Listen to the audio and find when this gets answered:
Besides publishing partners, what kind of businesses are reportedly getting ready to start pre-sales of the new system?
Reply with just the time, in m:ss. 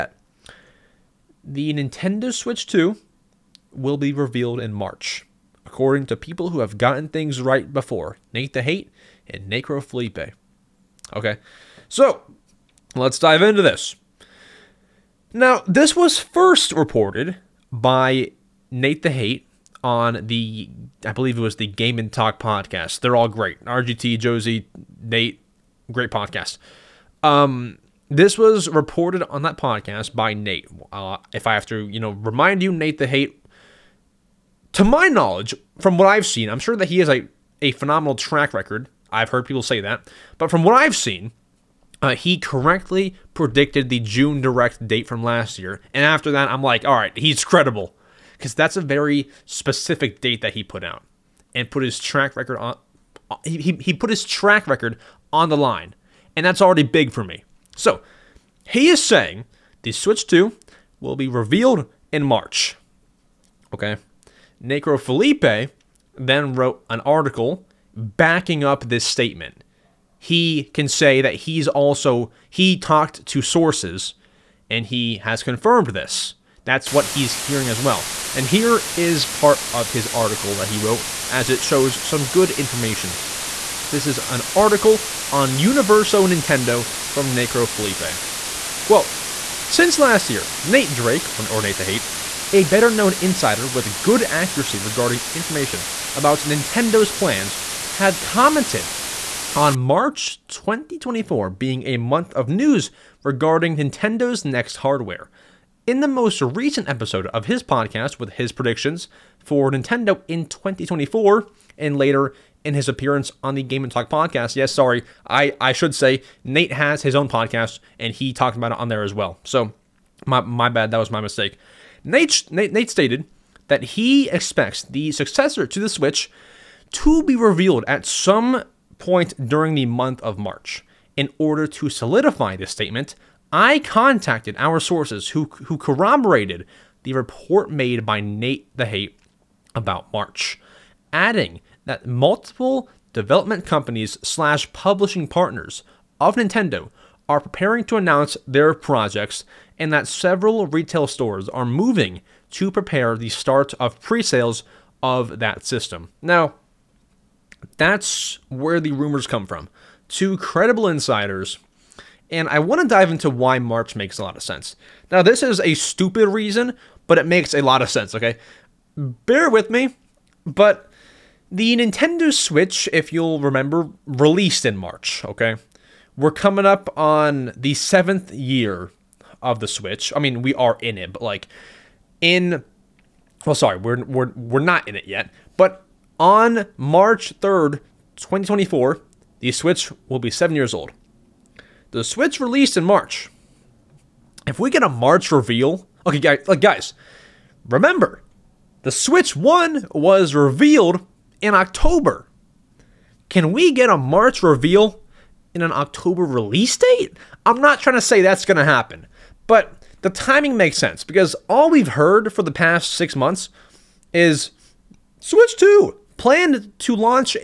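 2:30.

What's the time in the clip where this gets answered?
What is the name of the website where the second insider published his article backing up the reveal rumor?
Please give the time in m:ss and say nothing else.
1:25.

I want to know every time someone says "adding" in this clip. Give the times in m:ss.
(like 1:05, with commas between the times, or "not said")
2:21.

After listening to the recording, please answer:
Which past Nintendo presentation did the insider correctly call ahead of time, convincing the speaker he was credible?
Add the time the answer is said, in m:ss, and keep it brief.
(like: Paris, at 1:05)
June Direct, at 0:43.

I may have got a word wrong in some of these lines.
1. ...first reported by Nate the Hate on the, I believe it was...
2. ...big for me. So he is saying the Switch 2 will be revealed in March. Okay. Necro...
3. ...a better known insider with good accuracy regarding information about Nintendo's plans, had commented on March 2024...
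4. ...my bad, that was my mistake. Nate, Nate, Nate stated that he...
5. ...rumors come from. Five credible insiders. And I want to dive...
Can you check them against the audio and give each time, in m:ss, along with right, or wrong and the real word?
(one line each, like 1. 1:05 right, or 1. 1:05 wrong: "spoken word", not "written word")
1. 0:16 right
2. 0:56 right
3. 1:32 right
4. 2:00 right
5. 2:38 wrong: "Two", not "Five".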